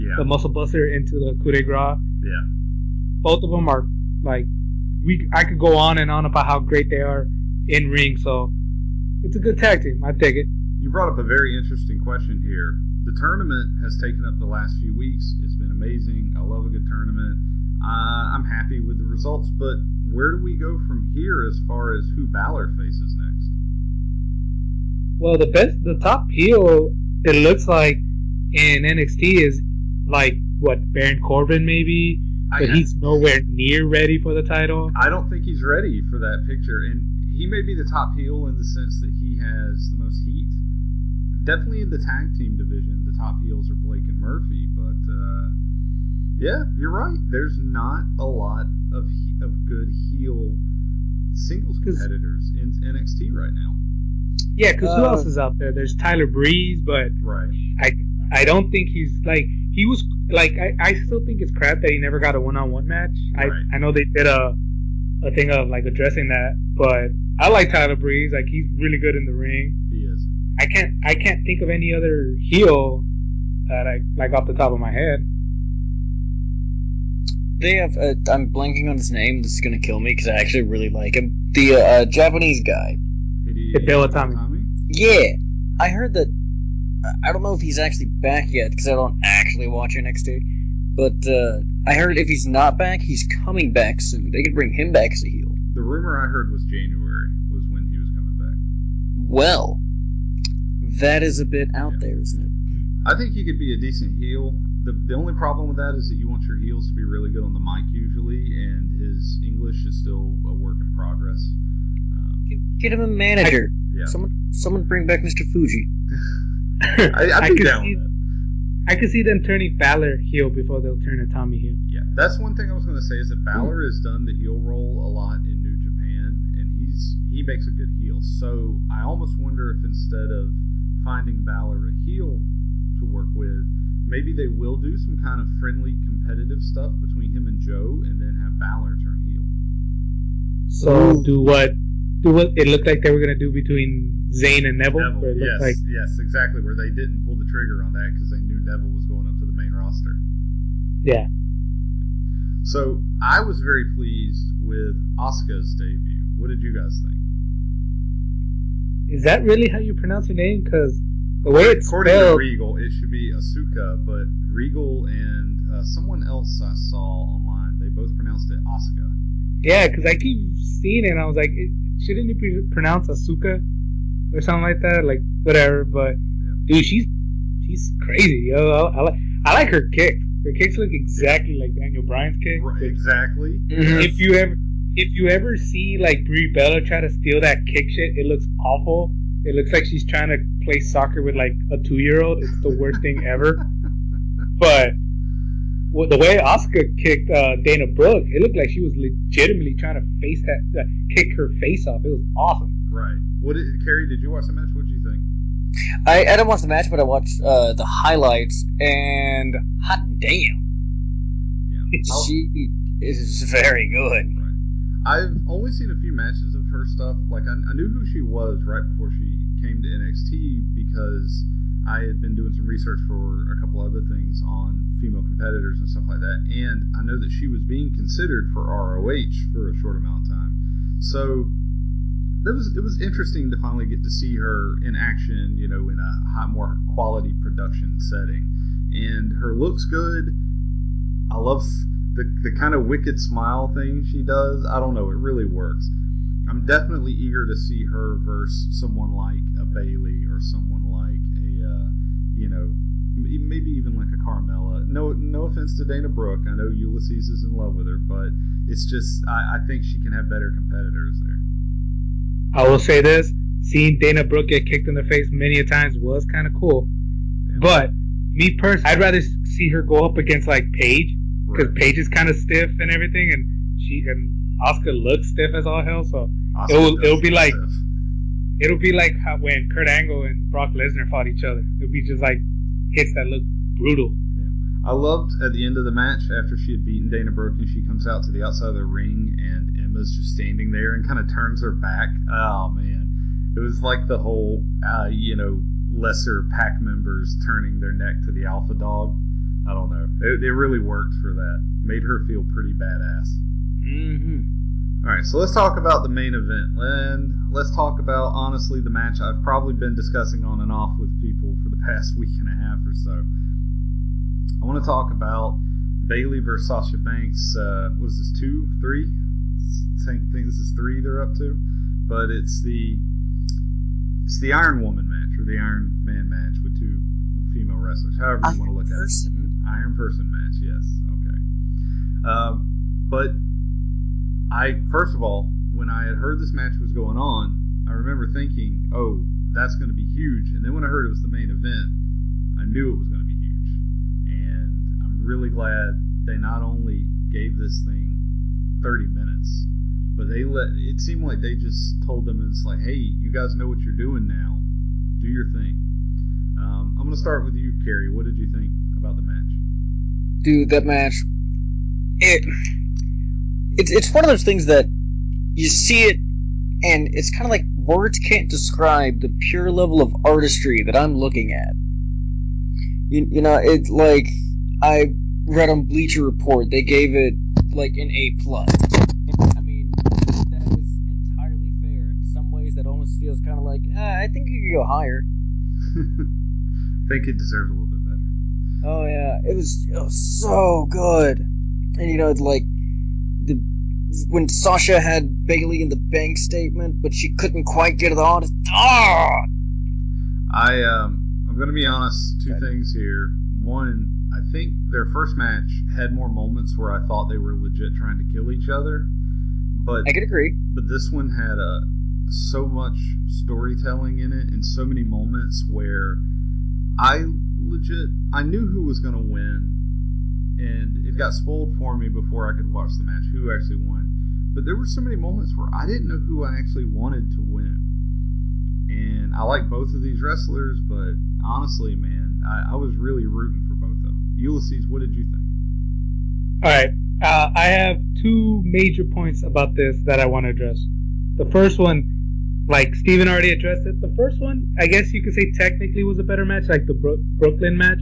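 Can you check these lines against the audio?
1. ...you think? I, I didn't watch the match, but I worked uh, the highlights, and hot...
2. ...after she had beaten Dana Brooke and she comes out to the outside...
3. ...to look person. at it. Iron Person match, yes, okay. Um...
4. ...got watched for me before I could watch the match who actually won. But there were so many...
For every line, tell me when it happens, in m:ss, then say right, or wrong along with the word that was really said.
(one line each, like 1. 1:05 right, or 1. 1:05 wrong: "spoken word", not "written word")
1. 3:24 wrong: "watched", not "worked"
2. 4:46 right
3. 5:28 right
4. 7:01 wrong: "spoiled", not "watched".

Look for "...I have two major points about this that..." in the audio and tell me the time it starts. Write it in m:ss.
7:17.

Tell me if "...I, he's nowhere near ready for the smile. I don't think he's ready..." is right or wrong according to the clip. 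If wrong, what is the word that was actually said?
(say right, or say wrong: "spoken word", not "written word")
wrong: "title", not "smile".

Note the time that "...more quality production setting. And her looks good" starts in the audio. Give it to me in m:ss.
3:56.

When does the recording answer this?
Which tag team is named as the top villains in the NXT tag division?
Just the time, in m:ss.
0:43.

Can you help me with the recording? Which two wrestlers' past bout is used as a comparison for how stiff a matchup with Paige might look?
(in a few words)
Kurt Angle and Brock Lesnar.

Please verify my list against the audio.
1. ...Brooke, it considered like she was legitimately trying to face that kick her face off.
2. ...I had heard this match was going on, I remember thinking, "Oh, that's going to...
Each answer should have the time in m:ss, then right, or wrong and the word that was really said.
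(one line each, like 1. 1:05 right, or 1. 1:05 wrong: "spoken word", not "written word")
1. 3:17 wrong: "looked", not "considered"
2. 5:35 right.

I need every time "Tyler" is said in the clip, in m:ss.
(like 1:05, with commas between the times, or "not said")
0:55, 1:07.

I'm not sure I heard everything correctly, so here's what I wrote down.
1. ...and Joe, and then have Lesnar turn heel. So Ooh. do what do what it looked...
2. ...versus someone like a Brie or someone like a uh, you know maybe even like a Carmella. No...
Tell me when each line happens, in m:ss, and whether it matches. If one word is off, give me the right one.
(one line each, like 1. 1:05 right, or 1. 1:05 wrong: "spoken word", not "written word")
1. 2:17 wrong: "Balor", not "Lesnar"
2. 4:08 wrong: "Bayley", not "Brie".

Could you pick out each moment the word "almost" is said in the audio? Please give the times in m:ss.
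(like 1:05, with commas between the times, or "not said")
2:09, 6:22.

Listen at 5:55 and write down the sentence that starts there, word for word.
Do your thing." Um, I'm going to start with you, Cary.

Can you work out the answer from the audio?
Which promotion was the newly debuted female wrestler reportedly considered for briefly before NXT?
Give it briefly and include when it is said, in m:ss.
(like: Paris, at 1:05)
ROH, at 3:48.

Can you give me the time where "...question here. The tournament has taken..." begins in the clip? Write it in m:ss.
0:11.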